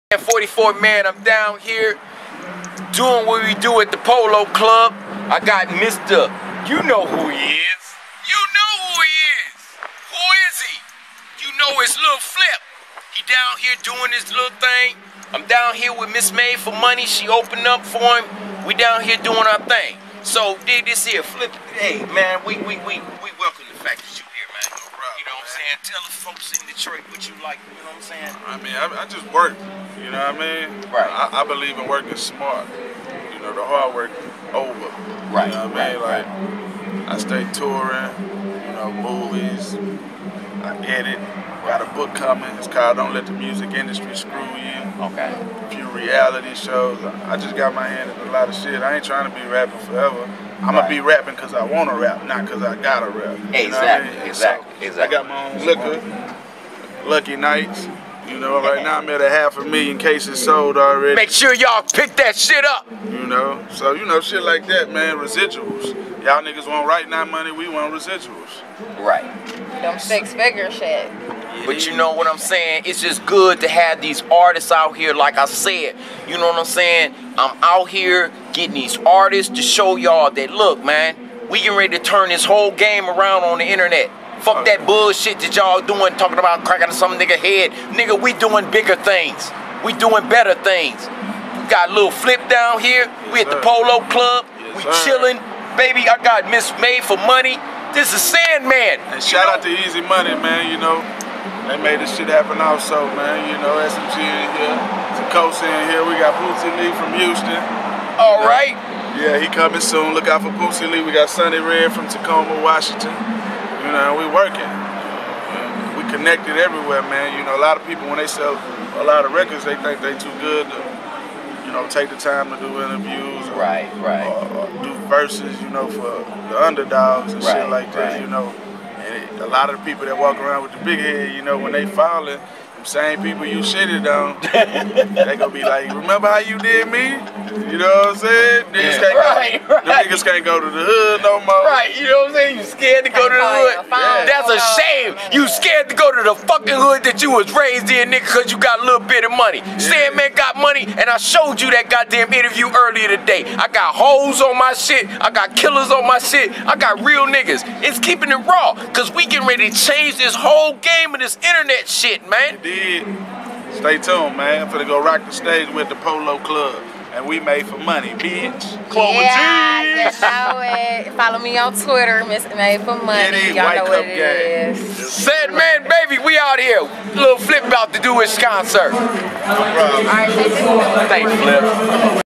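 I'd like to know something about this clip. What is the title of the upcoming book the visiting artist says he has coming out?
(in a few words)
Don't Let the Music Industry Screw You.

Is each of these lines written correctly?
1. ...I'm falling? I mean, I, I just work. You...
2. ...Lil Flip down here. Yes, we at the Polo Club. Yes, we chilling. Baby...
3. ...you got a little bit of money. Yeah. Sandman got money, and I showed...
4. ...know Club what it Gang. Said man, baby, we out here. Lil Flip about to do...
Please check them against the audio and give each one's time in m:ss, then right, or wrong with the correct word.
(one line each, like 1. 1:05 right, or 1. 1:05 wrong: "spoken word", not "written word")
1. 0:27 wrong: "saying", not "falling"
2. 1:31 right
3. 2:28 right
4. 2:53 right.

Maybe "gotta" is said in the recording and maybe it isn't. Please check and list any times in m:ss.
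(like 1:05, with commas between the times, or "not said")
0:52.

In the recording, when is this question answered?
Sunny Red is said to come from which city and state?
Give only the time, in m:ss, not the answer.
1:52.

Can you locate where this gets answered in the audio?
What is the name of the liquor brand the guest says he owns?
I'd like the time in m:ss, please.
0:57.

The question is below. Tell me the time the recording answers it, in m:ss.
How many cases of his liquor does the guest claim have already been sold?
0:59.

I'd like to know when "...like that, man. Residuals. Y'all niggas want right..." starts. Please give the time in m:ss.
1:04.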